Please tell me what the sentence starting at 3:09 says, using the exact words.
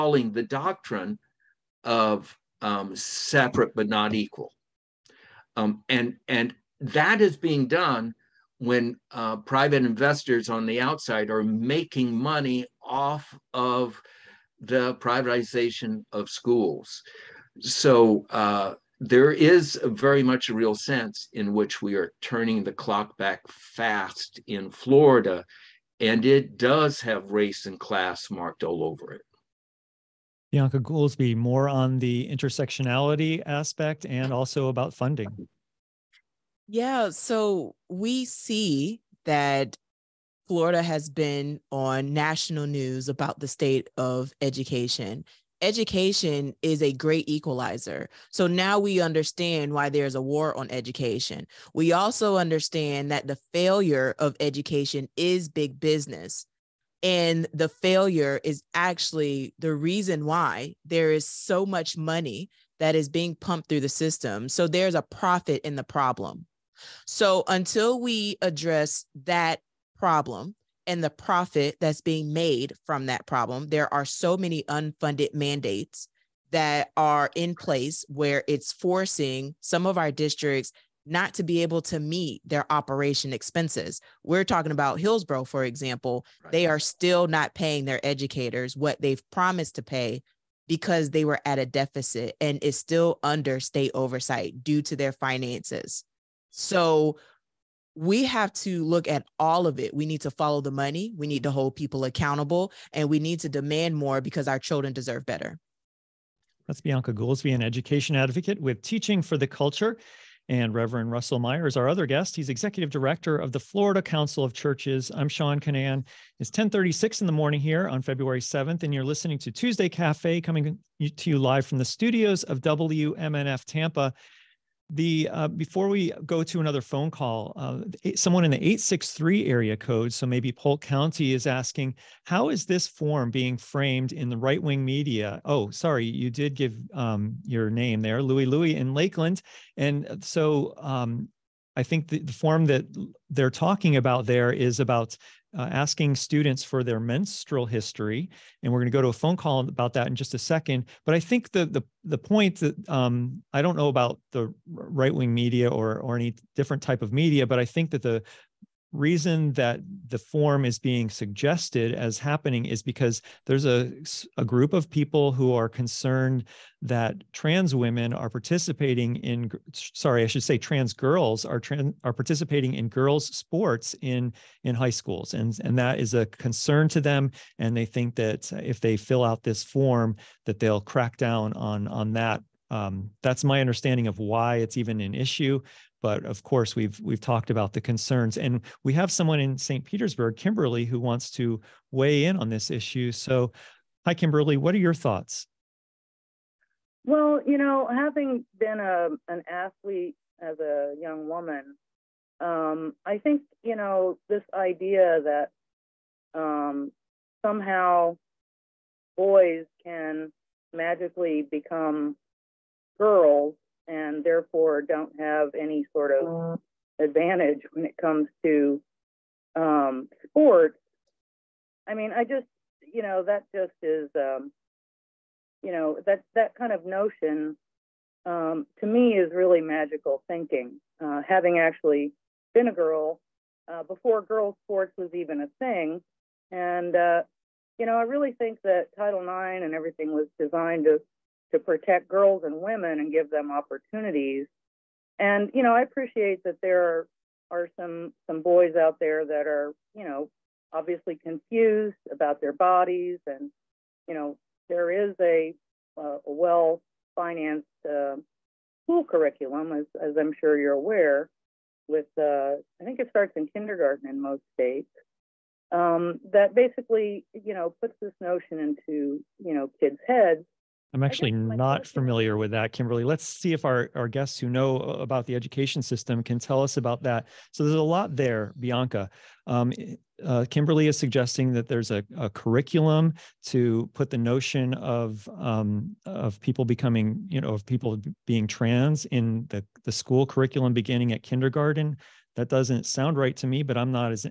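Petersburg, Kimberly, who wants to weigh in on this issue.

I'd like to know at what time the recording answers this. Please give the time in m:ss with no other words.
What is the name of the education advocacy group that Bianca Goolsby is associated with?
1:48.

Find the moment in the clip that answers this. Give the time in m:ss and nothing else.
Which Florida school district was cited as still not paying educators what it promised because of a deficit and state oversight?
1:24.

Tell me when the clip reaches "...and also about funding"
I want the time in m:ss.
0:34.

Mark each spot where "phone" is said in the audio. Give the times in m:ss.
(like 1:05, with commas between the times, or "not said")
2:06, 2:29.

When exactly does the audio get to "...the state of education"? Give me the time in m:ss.
0:43.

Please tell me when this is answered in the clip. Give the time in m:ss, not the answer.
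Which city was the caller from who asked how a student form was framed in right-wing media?
2:18.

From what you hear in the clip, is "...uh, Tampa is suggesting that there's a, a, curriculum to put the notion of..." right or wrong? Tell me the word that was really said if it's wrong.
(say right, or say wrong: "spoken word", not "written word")
wrong: "Kimberly", not "Tampa".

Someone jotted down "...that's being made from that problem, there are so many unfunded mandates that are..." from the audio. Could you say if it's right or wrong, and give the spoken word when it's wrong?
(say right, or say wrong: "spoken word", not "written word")
right.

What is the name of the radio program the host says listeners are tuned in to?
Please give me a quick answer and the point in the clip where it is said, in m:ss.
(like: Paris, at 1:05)
Tuesday Cafe, at 1:59.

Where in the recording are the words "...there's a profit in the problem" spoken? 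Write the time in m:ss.
1:04.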